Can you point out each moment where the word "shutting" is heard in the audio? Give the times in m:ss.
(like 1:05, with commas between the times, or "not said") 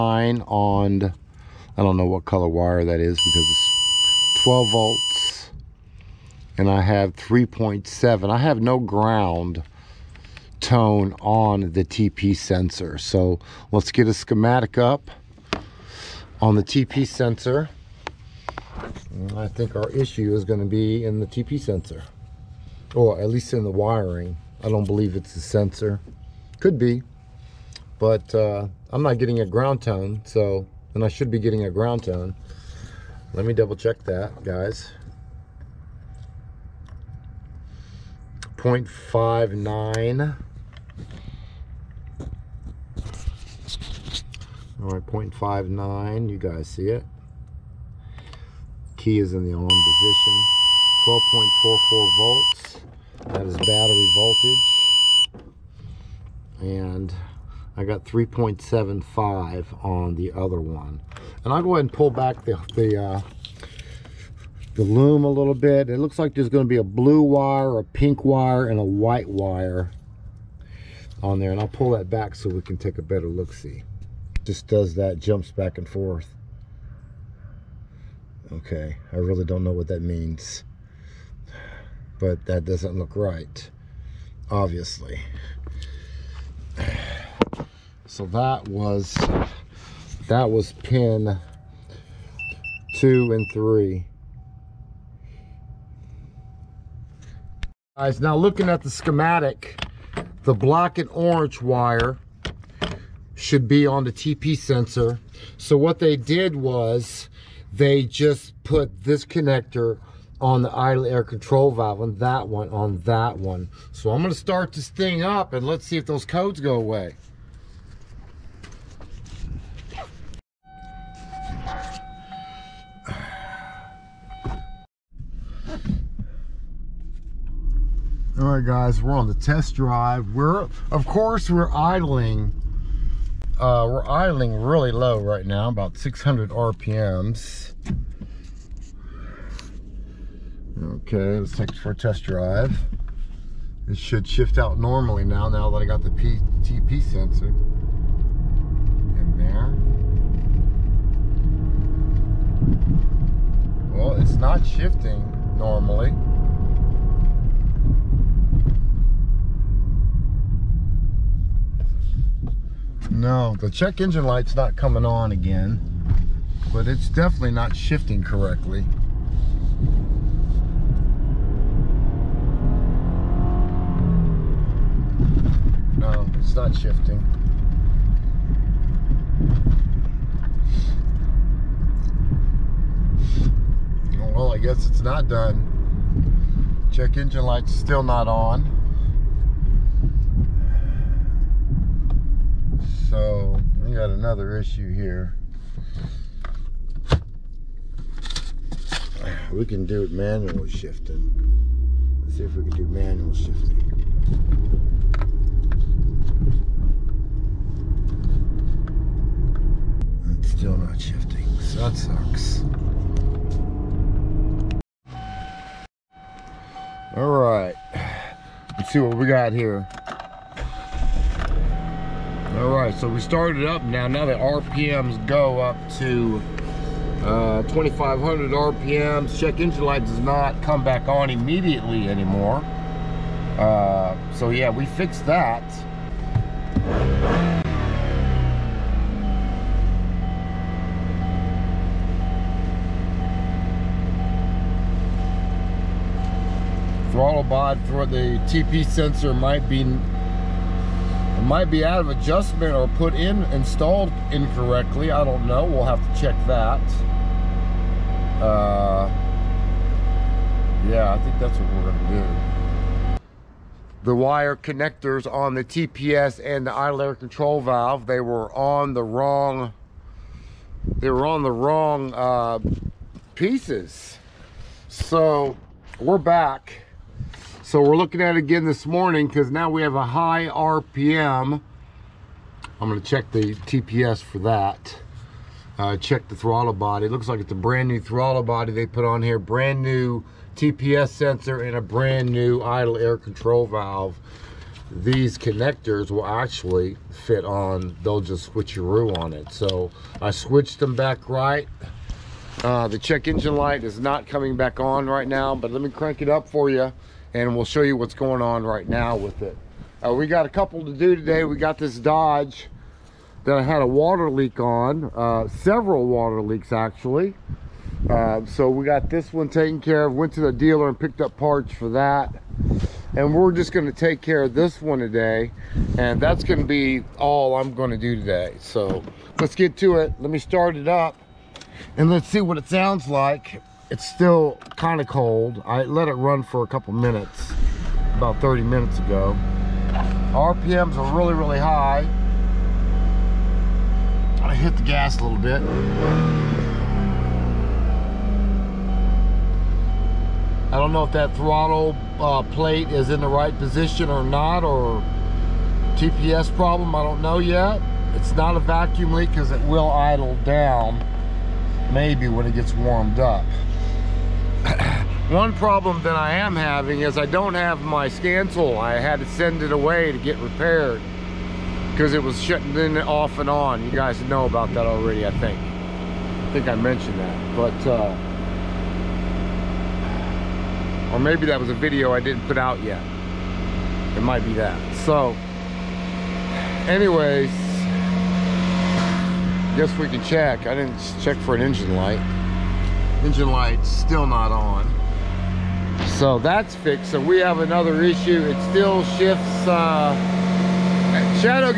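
6:12.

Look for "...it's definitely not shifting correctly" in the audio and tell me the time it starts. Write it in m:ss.
2:46.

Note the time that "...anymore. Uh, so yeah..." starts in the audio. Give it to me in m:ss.
3:52.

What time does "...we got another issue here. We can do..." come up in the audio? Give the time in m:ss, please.
3:13.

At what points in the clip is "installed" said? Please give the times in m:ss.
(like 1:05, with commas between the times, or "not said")
4:13.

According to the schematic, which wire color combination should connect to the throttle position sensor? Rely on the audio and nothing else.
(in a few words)
black and orange.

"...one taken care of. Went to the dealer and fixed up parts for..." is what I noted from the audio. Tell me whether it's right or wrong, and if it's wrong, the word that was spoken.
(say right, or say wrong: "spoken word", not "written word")
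wrong: "picked", not "fixed".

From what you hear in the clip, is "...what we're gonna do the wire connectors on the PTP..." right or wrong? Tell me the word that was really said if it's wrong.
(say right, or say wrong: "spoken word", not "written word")
wrong: "TPS", not "PTP".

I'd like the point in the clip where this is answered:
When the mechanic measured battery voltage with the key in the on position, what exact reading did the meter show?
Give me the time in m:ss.
0:51.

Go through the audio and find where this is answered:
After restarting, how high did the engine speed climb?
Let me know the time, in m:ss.
3:47.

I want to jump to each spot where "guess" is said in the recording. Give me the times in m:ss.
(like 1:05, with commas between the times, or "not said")
3:04, 6:29.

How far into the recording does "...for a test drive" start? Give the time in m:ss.
2:21.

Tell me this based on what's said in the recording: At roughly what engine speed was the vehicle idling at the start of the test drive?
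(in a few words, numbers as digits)
600 RPM.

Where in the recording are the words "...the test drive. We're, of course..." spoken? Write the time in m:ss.
2:09.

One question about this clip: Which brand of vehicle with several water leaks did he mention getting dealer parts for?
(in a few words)
Dodge.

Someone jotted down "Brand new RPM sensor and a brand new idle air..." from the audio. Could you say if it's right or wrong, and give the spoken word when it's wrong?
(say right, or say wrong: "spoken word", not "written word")
wrong: "TPS", not "RPM".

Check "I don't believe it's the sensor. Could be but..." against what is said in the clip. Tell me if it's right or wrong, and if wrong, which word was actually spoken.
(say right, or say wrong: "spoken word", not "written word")
right.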